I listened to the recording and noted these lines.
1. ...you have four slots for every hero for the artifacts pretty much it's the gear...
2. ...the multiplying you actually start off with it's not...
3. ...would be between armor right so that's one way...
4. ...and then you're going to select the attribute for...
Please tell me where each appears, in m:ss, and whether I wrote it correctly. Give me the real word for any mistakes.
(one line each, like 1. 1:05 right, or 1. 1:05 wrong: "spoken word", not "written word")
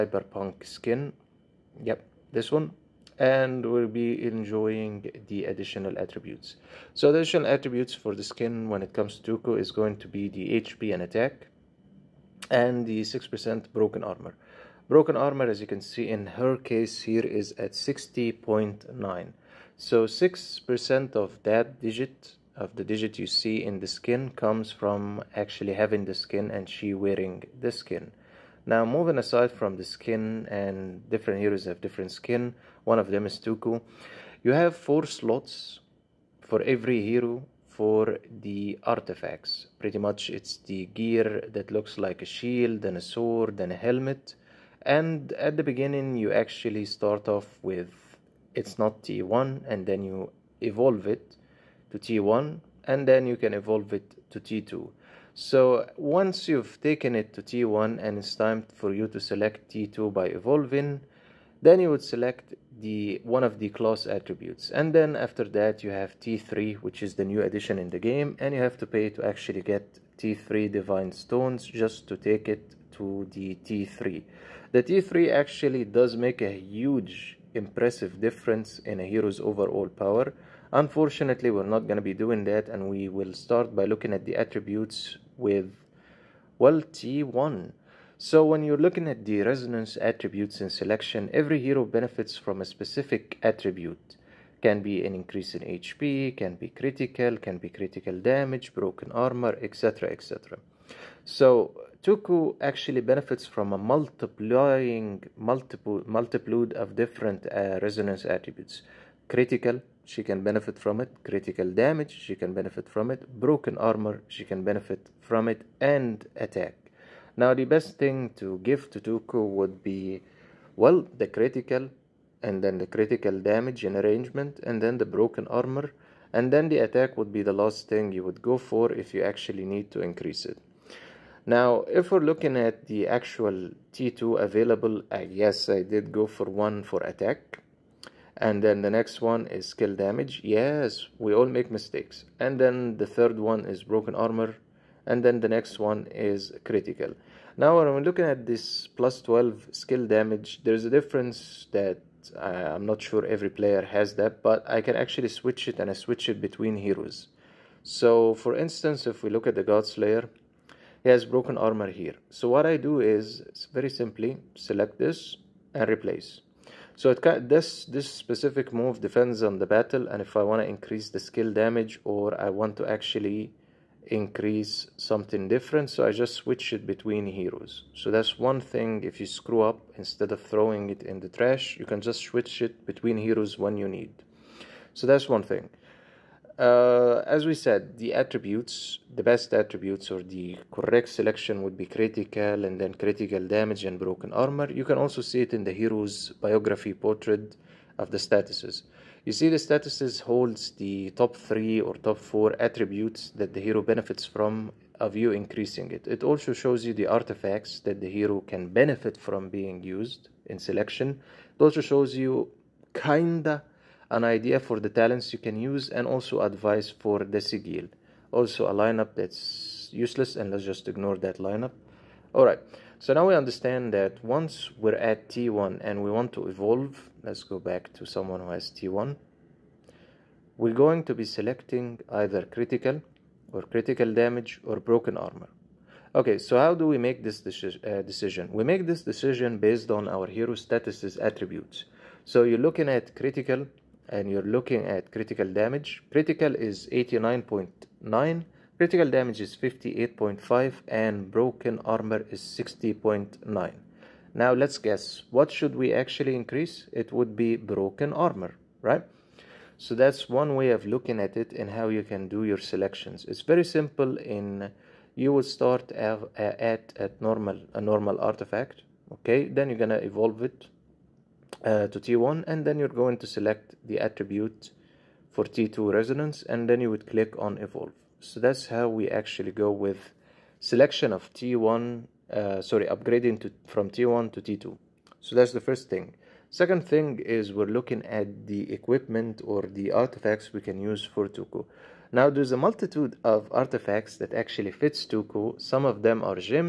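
1. 0:34 right
2. 0:45 wrong: "beginning", not "multiplying"
3. 4:17 wrong: "broken", not "between"
4. 4:32 right.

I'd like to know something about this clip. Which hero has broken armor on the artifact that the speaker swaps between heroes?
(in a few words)
God Slayer.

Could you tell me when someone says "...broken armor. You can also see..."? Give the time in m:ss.
3:13.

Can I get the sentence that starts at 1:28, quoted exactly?
So when you're looking at the resonance attributes in selection, every hero benefits from a specific attribute.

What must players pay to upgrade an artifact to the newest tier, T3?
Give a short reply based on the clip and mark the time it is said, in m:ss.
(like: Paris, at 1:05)
Divine stones, at 1:10.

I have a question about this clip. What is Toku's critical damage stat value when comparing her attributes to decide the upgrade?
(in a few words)
58.5.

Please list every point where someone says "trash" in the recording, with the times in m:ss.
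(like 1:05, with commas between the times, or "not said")
3:01.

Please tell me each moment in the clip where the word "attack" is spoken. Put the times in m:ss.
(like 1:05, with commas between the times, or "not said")
0:11, 1:56, 2:06, 2:17.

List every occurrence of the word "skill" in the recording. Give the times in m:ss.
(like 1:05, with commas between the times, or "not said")
2:19, 2:29, 2:51.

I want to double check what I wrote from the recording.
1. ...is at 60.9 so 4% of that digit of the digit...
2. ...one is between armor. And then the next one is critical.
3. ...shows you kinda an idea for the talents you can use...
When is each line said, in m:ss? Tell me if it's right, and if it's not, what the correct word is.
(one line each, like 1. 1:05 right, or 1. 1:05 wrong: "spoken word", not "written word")
1. 0:17 wrong: "6", not "4"
2. 2:23 wrong: "broken", not "between"
3. 3:31 right.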